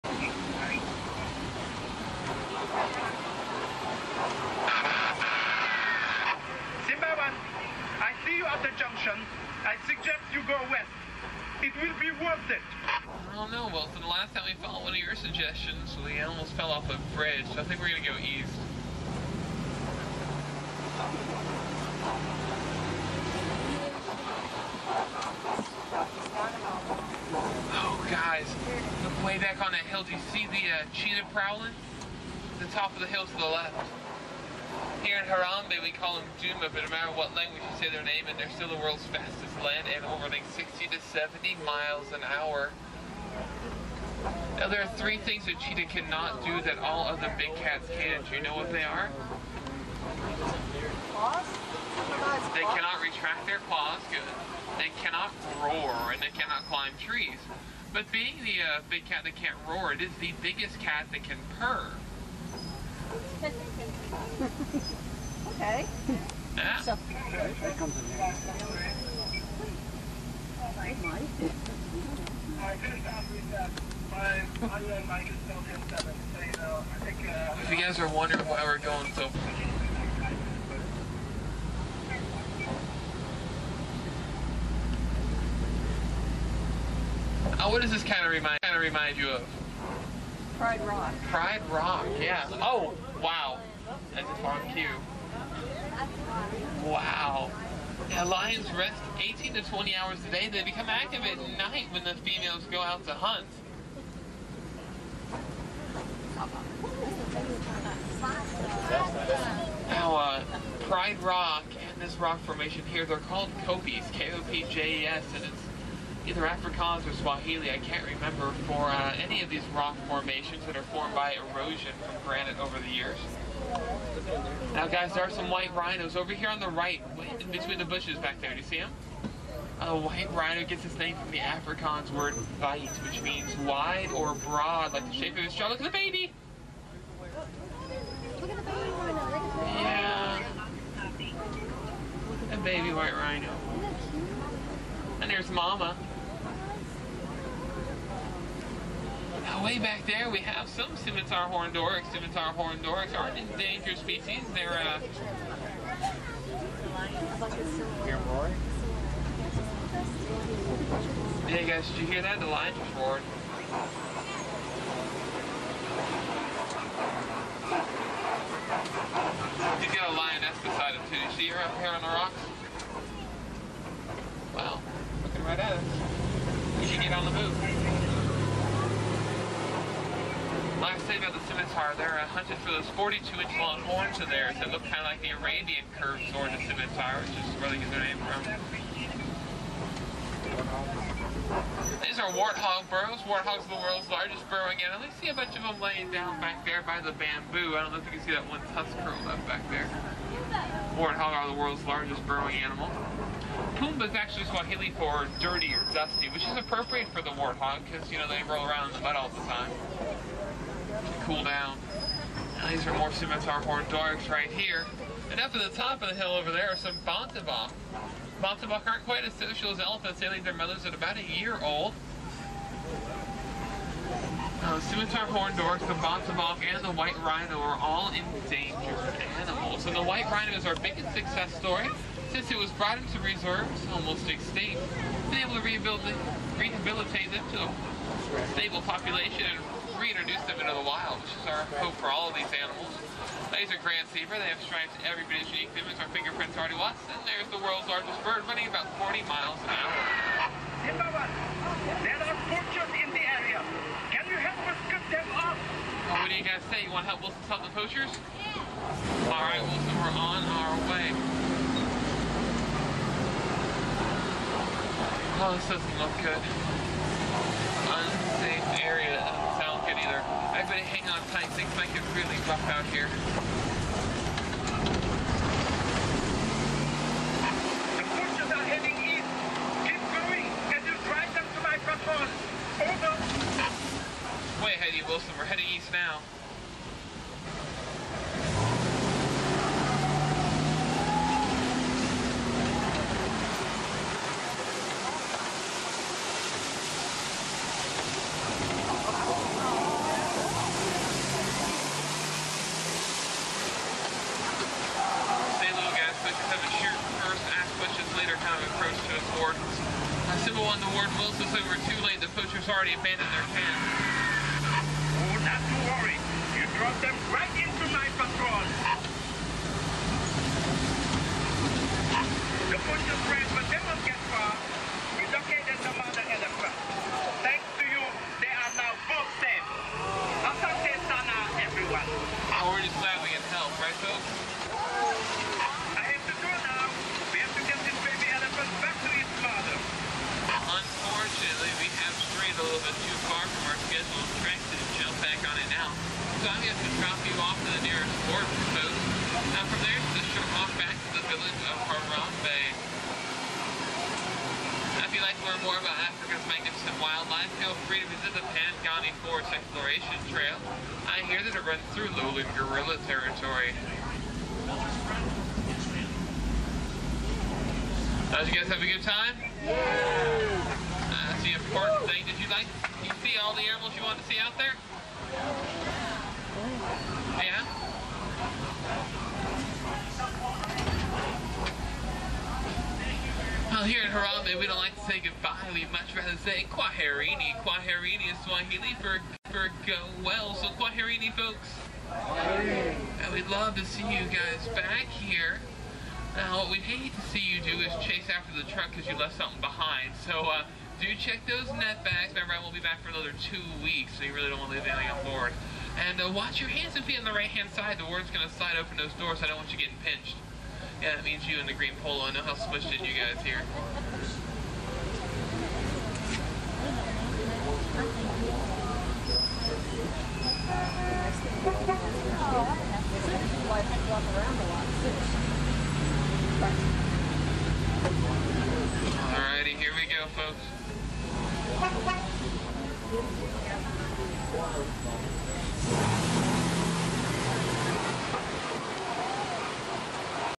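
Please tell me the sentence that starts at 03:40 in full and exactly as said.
They leave their mothers at about a year old.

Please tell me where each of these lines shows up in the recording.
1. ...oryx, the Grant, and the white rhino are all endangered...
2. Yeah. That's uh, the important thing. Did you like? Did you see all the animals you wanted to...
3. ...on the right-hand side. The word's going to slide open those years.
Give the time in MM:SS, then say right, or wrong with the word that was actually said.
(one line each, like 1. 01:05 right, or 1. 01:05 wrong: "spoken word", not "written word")
1. 03:45 wrong: "Bontebok", not "Grant"
2. 06:09 right
3. 06:47 wrong: "doors", not "years".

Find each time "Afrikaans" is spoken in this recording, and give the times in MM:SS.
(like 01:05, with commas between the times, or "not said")
01:56, 02:11.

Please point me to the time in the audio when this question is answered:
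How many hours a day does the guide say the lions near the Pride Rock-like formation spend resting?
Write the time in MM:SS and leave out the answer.
01:39.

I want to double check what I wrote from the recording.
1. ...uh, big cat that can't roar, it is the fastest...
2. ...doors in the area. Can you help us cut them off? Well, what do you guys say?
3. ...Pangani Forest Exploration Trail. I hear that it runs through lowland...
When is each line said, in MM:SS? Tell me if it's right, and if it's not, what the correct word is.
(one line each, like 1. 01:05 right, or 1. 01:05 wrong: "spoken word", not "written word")
1. 00:58 wrong: "biggest", not "fastest"
2. 04:12 wrong: "poachers", not "doors"
3. 05:58 right.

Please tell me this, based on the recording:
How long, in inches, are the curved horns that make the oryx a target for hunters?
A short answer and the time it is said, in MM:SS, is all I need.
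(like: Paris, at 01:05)
42, at 03:02.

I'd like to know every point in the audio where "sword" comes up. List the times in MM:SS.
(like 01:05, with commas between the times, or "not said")
03:06.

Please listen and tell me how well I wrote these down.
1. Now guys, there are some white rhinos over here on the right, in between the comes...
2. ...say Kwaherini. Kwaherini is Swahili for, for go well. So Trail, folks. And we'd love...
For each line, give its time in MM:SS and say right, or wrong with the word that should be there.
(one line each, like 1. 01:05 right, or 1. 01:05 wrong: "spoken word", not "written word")
1. 02:04 wrong: "bushes", not "comes"
2. 06:26 wrong: "Kwaherini", not "Trail".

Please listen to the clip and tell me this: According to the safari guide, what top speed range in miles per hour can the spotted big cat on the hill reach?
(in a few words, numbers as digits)
60 to 70.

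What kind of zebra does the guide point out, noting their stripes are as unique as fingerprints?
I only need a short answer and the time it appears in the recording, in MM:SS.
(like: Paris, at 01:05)
Grant's zebra, at 04:03.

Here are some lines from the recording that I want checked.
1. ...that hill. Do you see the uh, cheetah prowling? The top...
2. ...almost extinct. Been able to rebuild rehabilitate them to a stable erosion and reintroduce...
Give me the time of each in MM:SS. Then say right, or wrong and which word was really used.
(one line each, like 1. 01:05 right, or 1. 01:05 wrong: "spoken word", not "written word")
1. 00:29 right
2. 03:53 wrong: "population", not "erosion".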